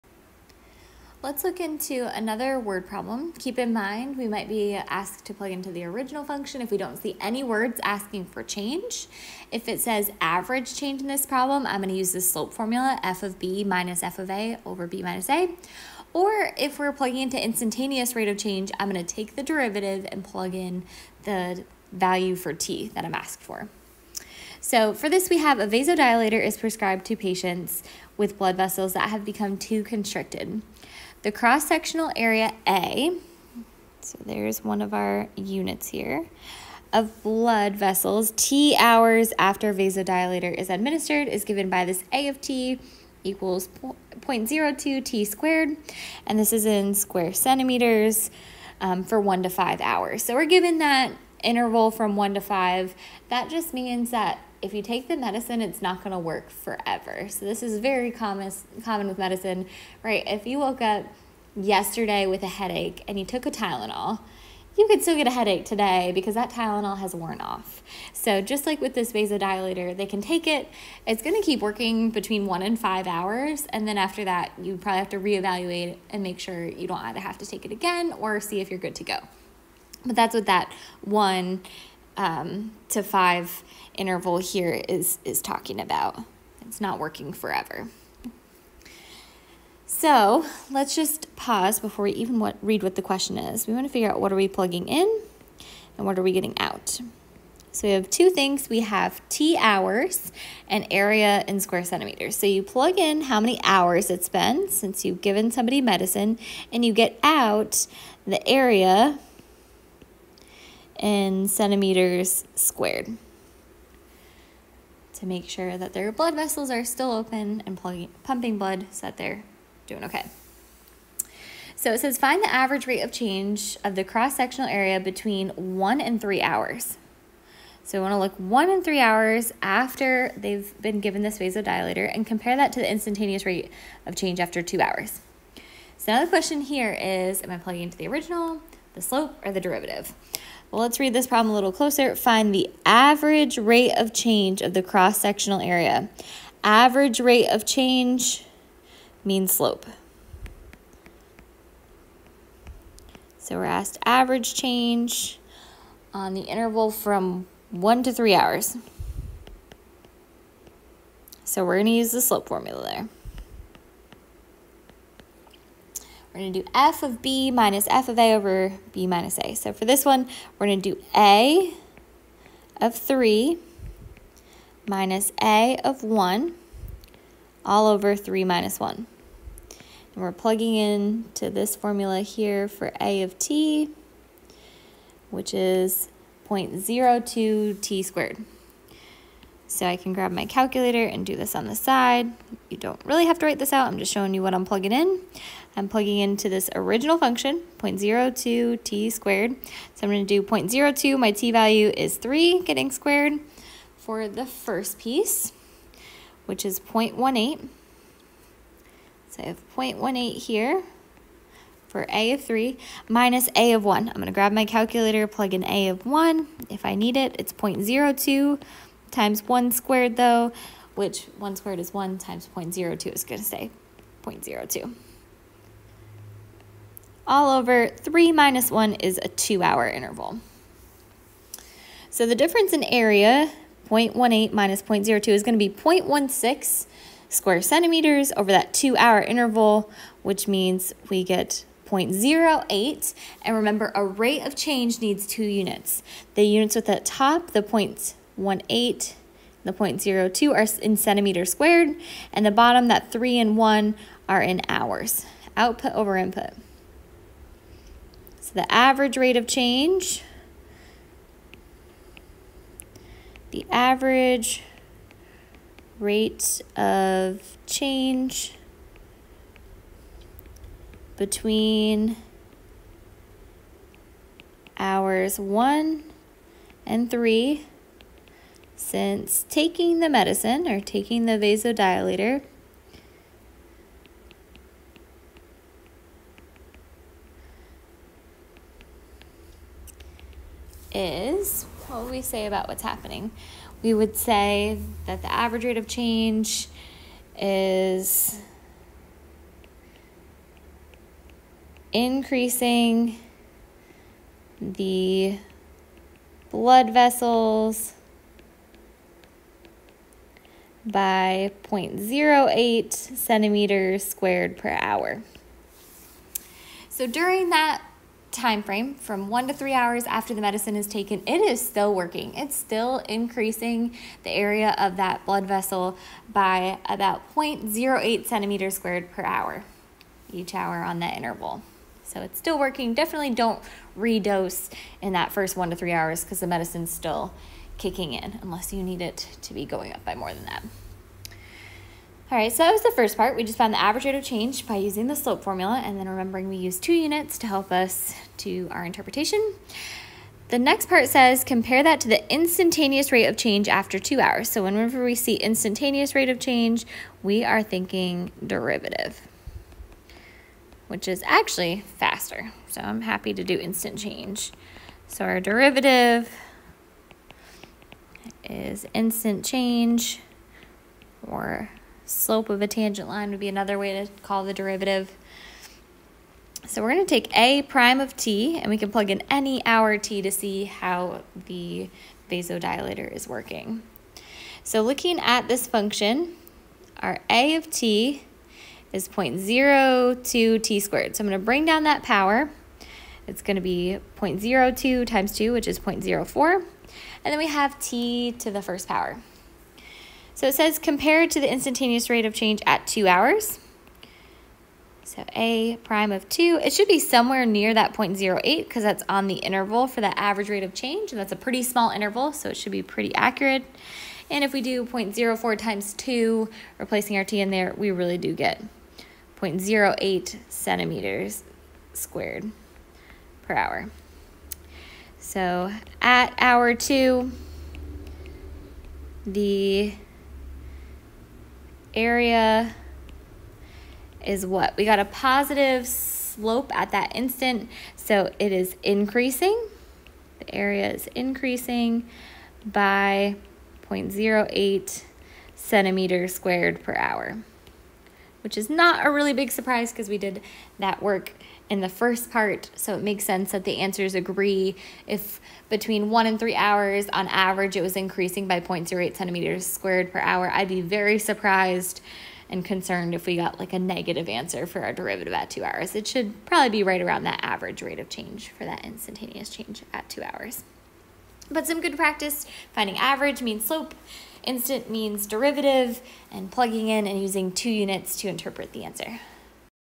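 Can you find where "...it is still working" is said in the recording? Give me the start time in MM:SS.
05:21.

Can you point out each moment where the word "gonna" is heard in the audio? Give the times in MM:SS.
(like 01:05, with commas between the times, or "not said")
00:11, 00:18, 02:41.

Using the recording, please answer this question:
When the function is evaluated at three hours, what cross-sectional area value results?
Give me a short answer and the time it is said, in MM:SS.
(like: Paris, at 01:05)
0.18, at 03:26.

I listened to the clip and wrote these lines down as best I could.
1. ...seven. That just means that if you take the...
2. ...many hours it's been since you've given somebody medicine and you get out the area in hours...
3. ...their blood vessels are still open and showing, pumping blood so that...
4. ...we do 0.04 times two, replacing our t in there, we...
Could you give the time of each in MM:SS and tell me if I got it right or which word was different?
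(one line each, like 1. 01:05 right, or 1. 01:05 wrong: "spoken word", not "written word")
1. 00:52 wrong: "five", not "seven"
2. 01:43 wrong: "centimeters", not "hours"
3. 01:55 wrong: "plugging", not "showing"
4. 06:54 right.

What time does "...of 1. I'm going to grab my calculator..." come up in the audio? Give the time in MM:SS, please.
03:33.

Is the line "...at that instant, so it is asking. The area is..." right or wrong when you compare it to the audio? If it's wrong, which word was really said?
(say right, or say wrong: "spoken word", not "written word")
wrong: "increasing", not "asking".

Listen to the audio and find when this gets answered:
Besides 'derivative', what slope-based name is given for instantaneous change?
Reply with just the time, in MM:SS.
06:12.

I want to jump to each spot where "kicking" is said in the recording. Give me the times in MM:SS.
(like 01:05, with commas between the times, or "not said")
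05:37.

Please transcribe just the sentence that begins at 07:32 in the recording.
So it makes sense that the answers agree.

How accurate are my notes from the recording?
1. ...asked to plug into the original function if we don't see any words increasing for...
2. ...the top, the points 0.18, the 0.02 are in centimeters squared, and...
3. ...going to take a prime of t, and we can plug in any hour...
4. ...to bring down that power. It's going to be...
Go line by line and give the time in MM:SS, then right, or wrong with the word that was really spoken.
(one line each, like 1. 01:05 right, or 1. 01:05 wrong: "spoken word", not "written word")
1. 00:04 wrong: "asking", not "increasing"
2. 04:06 right
3. 06:16 right
4. 06:31 right.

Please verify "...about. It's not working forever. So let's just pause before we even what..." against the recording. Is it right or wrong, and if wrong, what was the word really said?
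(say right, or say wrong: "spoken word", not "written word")
right.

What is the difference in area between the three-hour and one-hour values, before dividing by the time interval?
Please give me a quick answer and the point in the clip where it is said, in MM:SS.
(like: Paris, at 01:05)
0.16 square centimeters, at 03:55.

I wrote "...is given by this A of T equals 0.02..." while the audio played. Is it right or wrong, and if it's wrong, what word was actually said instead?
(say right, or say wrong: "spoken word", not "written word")
right.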